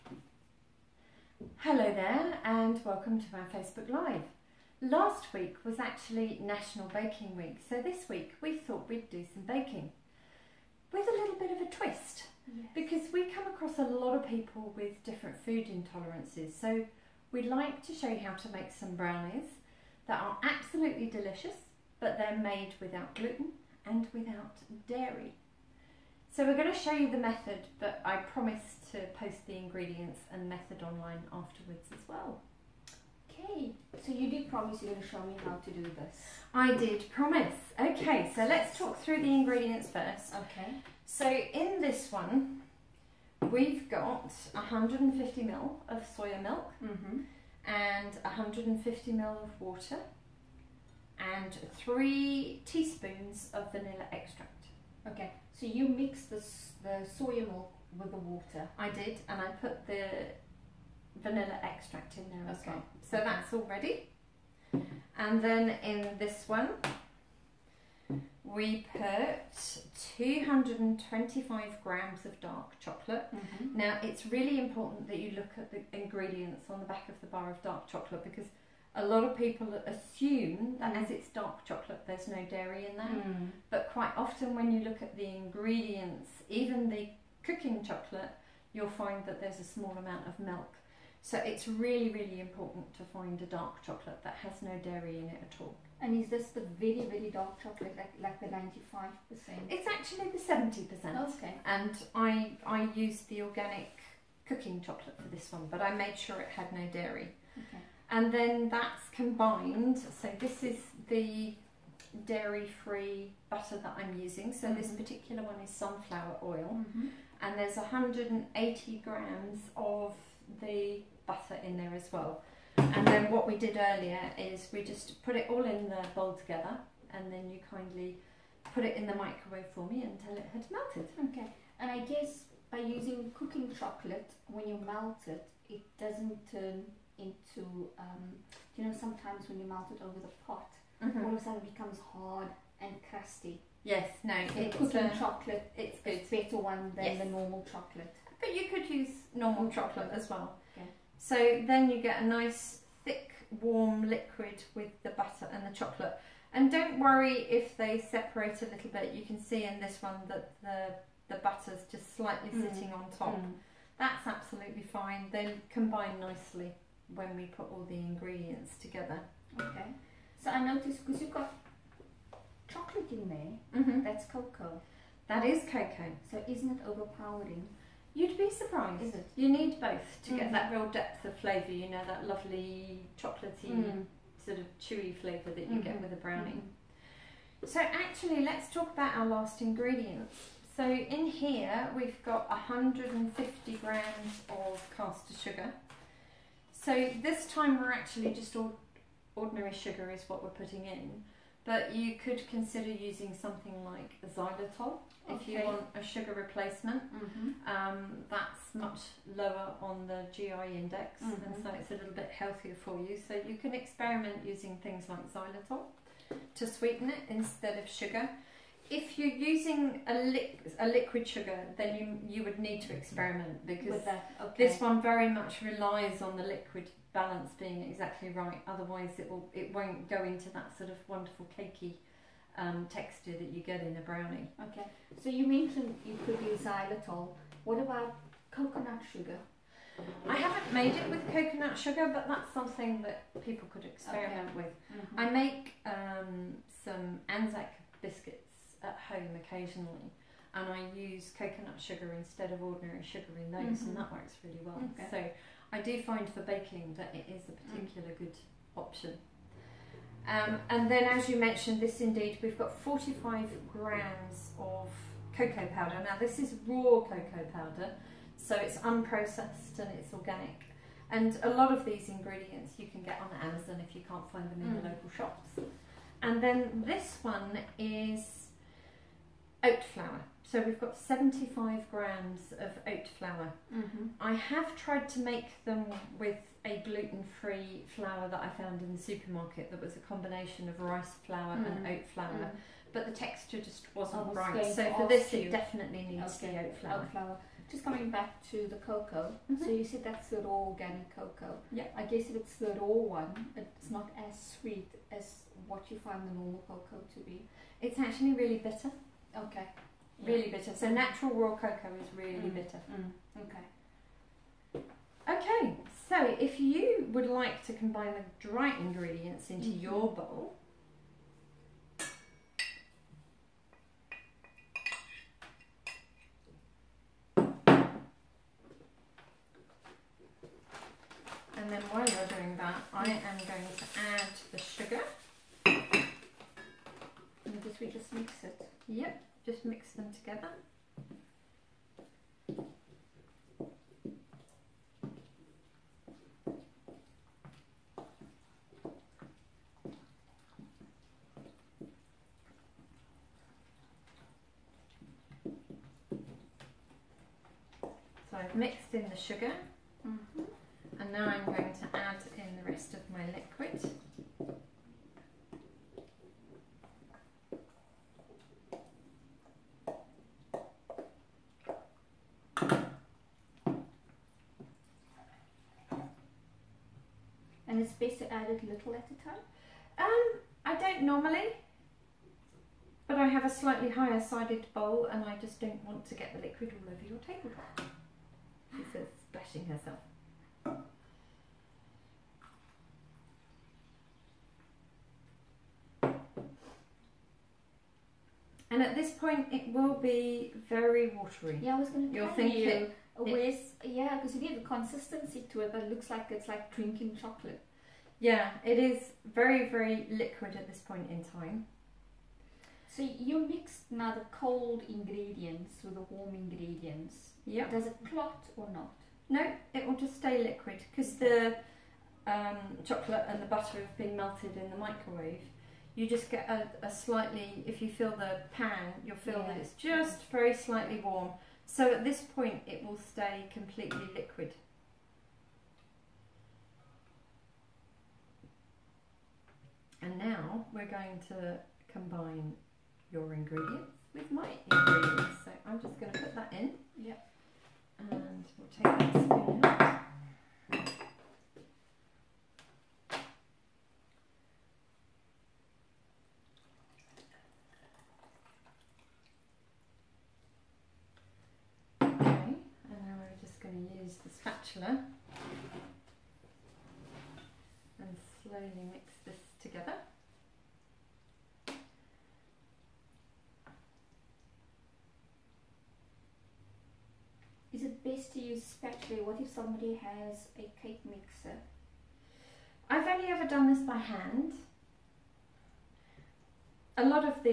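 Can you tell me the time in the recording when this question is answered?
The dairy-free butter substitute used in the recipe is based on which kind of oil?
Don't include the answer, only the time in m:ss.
1:55.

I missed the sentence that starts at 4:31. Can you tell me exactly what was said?
And a lot of these ingredients you can get on Amazon if you can't find them in mm.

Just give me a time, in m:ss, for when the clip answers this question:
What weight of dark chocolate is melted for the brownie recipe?
1:10.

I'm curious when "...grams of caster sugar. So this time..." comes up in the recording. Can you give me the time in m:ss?
3:13.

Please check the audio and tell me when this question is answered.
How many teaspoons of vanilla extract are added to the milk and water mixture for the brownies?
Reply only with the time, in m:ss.
0:51.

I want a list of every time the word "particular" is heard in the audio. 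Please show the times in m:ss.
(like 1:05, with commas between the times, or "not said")
1:55, 4:17.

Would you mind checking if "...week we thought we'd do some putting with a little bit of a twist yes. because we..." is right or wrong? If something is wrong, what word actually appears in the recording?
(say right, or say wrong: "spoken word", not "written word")
wrong: "baking", not "putting".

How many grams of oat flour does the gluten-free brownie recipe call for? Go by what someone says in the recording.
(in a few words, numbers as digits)
75 grams.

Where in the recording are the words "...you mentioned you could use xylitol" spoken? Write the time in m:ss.
3:55.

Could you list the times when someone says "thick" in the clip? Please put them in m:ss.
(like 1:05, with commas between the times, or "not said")
2:33.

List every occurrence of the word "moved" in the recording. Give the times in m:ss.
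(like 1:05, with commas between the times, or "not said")
not said.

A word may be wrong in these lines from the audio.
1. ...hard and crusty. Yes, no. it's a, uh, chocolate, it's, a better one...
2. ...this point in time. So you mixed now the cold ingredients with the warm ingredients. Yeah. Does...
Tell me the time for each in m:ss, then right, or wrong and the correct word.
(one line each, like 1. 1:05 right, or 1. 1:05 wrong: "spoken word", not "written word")
1. 2:22 right
2. 6:50 right.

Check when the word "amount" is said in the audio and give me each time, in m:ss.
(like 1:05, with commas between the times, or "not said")
1:29.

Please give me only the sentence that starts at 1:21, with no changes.
as it's dark chocolate, there's no dairy in there.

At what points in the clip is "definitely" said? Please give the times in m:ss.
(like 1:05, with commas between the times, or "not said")
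4:55.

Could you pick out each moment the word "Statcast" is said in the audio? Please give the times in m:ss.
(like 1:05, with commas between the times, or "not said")
not said.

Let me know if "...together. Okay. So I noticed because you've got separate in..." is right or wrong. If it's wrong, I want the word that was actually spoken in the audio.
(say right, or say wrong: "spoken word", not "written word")
wrong: "chocolate", not "separate".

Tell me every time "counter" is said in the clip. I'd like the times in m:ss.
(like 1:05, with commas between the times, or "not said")
not said.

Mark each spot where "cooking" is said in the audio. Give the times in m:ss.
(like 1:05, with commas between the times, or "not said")
1:27, 1:44, 2:13.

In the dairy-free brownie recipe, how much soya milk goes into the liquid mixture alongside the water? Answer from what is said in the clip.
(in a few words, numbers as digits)
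150 ml.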